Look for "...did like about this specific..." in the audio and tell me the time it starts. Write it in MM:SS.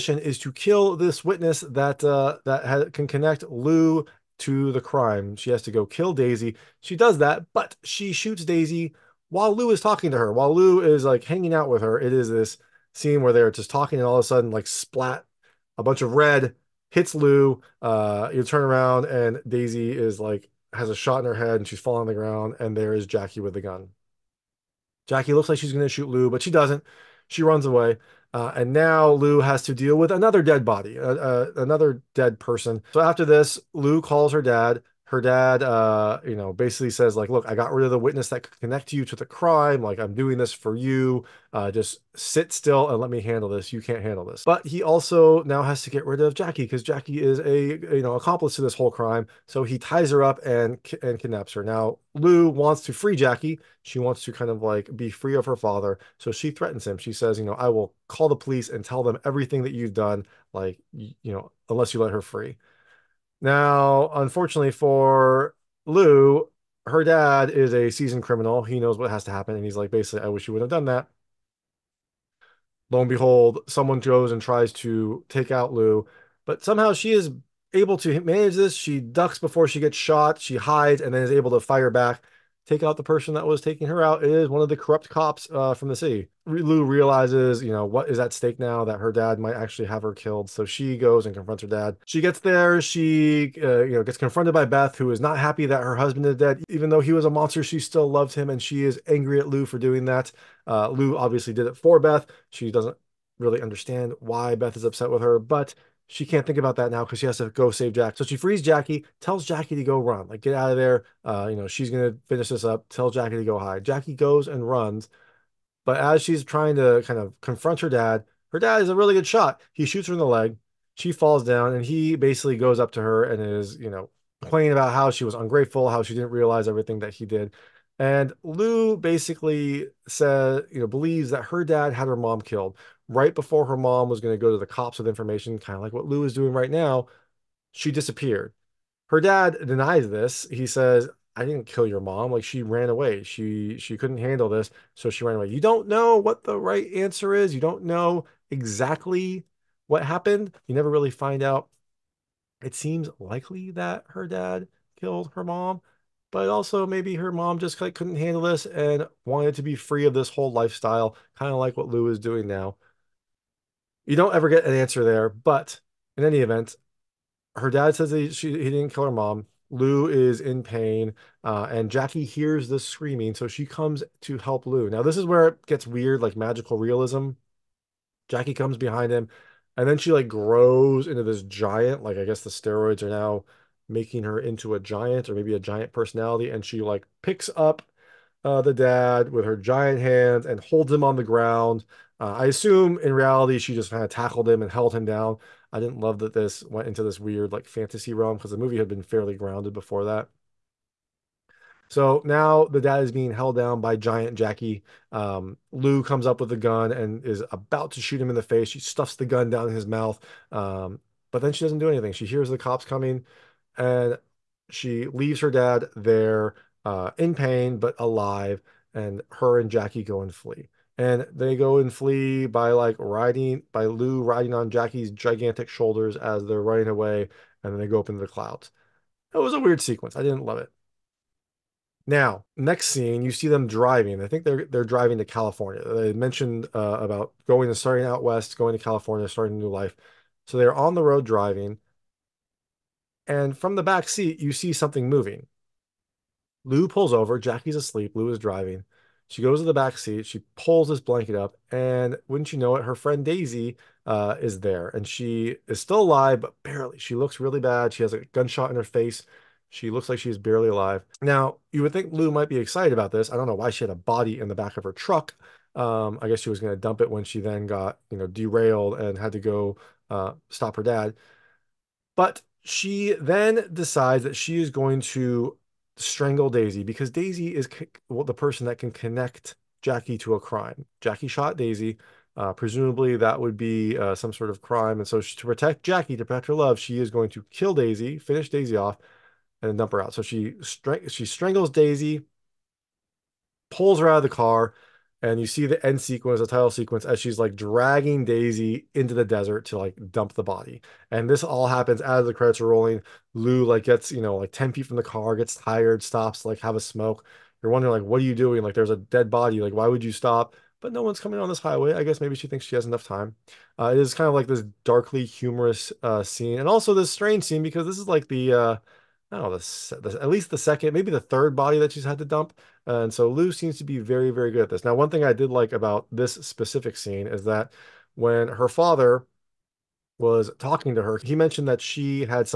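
05:25.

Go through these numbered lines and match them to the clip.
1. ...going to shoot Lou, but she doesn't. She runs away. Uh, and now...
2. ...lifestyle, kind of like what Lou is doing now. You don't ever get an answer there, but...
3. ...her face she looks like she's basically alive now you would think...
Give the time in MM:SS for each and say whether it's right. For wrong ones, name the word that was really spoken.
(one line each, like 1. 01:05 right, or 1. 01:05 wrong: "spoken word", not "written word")
1. 00:25 right
2. 02:40 right
3. 04:18 wrong: "barely", not "basically".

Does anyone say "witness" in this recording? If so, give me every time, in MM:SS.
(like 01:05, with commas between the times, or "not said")
00:01, 00:37.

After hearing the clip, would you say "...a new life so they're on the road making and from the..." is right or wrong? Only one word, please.
wrong.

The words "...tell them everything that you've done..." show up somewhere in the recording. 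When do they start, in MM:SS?
00:58.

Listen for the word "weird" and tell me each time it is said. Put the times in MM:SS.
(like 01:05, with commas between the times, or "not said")
02:55, 03:17, 03:49.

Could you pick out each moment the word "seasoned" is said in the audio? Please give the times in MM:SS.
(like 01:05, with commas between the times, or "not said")
01:07.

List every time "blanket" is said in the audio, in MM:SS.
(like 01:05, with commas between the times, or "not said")
04:10.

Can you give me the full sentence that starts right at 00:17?
Uh, you turn around and Daisy is like has a shot in her head and she's falling on the ground.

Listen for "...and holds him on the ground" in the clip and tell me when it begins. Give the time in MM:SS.
03:10.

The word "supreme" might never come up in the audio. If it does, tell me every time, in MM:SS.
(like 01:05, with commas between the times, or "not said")
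not said.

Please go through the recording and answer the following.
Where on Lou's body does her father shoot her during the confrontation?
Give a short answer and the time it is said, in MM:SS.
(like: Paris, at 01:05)
The leg, at 01:59.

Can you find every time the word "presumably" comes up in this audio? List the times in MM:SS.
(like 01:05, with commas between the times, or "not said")
04:42.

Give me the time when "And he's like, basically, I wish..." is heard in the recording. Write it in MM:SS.
01:09.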